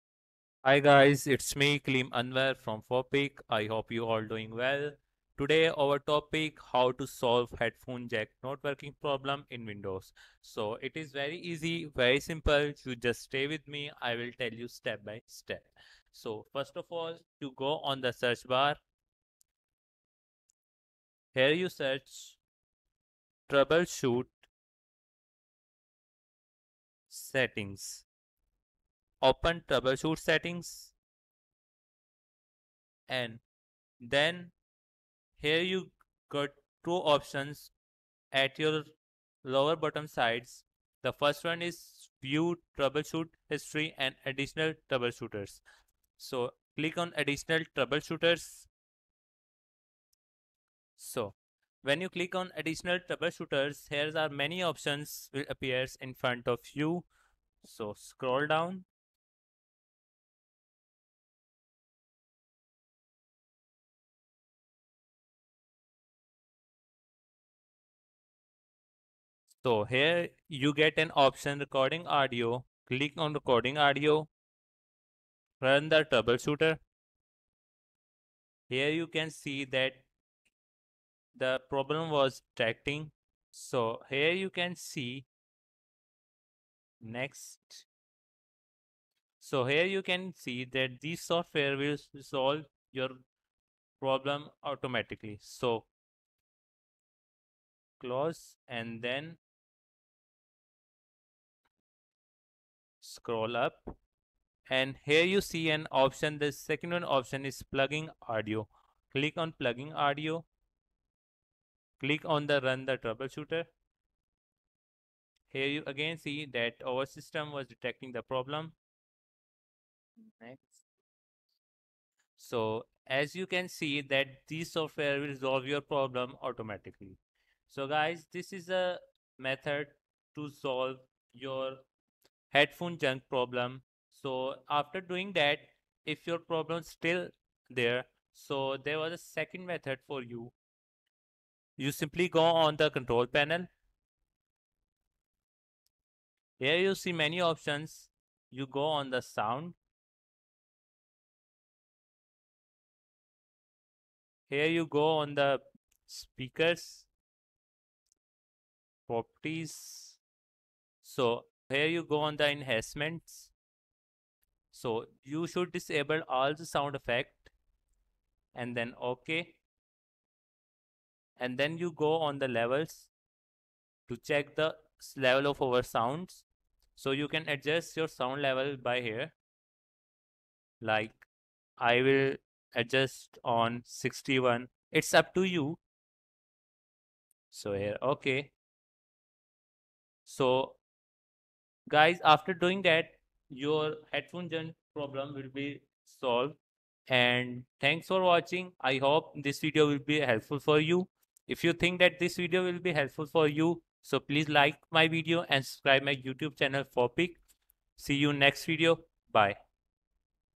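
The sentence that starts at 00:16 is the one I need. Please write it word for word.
So first of all, you go on the search bar.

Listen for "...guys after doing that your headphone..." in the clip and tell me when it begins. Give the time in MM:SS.
03:11.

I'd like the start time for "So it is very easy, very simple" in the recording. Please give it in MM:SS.
00:10.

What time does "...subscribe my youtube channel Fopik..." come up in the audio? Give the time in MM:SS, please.
03:25.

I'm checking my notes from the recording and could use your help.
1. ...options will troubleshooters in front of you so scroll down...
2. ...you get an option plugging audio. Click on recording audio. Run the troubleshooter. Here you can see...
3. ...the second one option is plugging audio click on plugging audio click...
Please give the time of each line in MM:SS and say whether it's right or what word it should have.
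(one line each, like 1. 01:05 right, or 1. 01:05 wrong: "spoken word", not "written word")
1. 00:54 wrong: "appears", not "troubleshooters"
2. 01:10 wrong: "recording", not "plugging"
3. 01:46 right.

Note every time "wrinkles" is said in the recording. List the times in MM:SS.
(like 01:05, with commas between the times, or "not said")
not said.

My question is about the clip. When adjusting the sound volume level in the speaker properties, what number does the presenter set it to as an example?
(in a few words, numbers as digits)
61.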